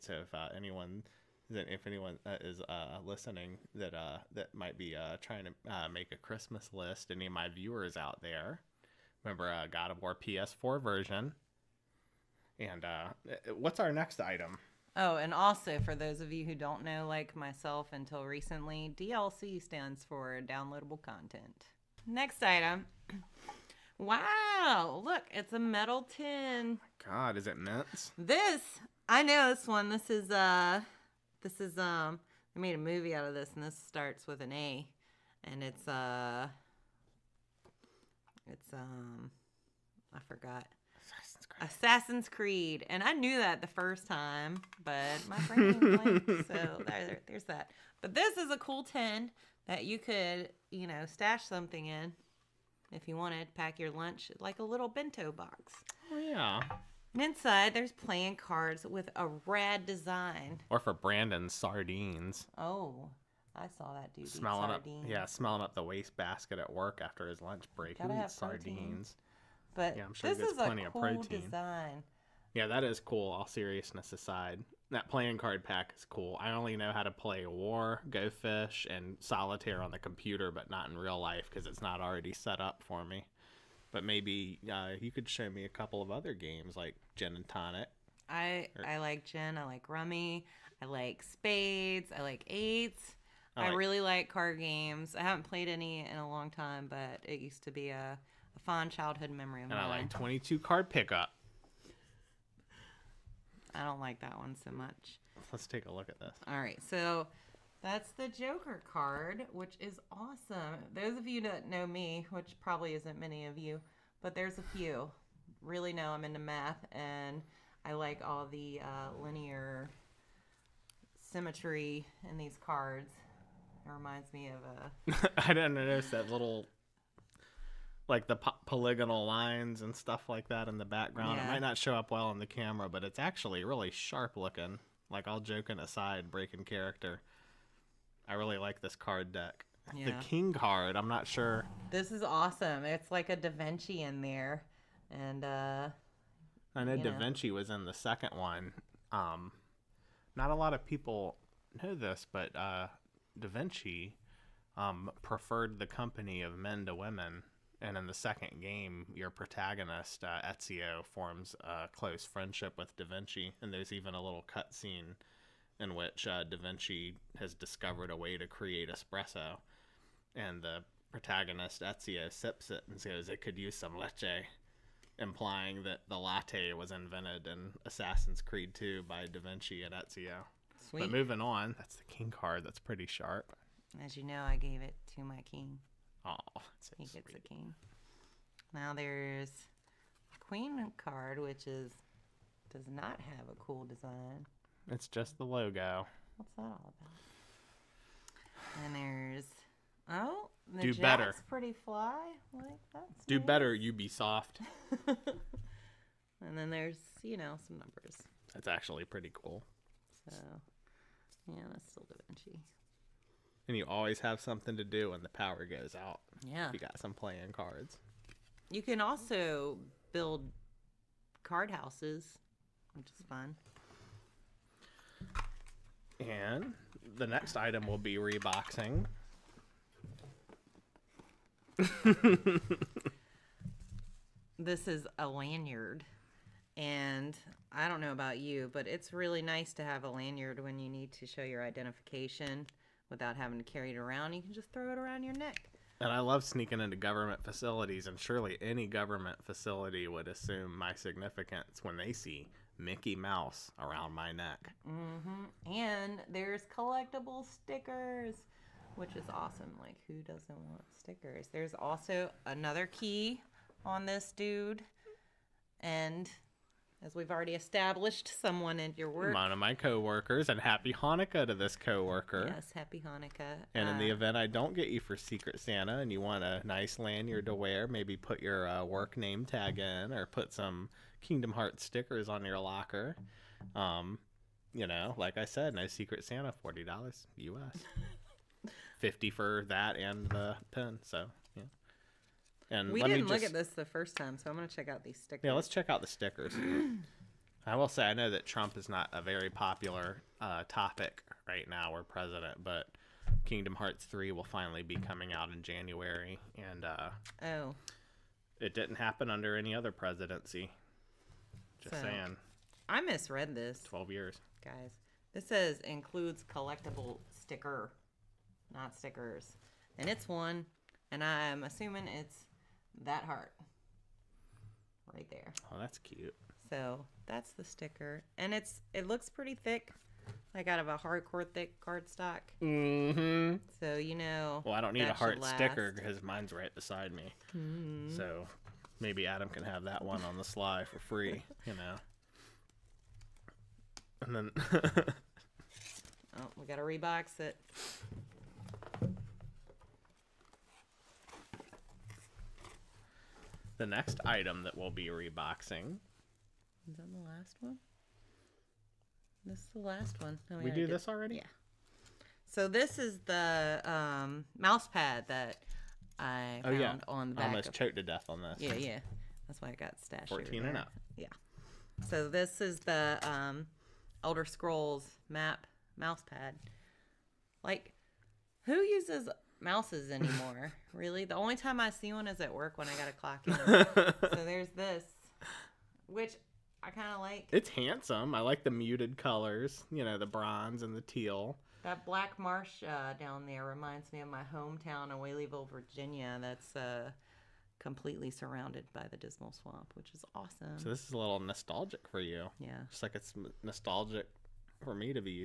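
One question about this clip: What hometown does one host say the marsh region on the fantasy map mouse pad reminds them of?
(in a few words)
Whaleyville, Virginia.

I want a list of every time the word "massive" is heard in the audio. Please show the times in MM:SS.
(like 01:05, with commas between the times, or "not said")
not said.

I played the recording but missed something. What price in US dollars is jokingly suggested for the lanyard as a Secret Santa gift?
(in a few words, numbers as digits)
40.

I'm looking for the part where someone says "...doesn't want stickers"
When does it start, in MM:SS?
04:20.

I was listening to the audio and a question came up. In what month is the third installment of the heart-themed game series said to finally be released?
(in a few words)
January.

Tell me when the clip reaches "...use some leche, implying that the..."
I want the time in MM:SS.
02:53.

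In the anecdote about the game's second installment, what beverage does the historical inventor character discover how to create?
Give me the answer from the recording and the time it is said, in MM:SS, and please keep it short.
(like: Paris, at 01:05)
espresso, at 02:48.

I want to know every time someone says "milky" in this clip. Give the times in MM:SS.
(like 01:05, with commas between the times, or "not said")
not said.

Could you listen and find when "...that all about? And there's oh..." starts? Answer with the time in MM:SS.
03:16.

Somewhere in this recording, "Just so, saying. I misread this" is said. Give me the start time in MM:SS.
05:11.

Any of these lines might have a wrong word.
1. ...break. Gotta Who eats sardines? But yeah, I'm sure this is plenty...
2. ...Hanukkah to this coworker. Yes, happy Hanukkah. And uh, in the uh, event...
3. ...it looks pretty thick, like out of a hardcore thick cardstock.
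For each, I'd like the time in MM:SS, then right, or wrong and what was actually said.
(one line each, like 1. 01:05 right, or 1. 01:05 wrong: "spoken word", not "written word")
1. 01:07 right
2. 04:30 right
3. 05:28 right.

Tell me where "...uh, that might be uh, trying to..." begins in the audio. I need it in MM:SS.
00:03.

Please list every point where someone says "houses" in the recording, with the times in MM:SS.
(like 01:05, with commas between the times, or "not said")
03:41.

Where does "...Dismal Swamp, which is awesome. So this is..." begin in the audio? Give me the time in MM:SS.
06:39.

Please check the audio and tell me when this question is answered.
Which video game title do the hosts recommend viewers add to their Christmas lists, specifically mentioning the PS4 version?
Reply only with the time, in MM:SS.
00:09.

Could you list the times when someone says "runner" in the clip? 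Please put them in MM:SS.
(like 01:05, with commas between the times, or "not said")
not said.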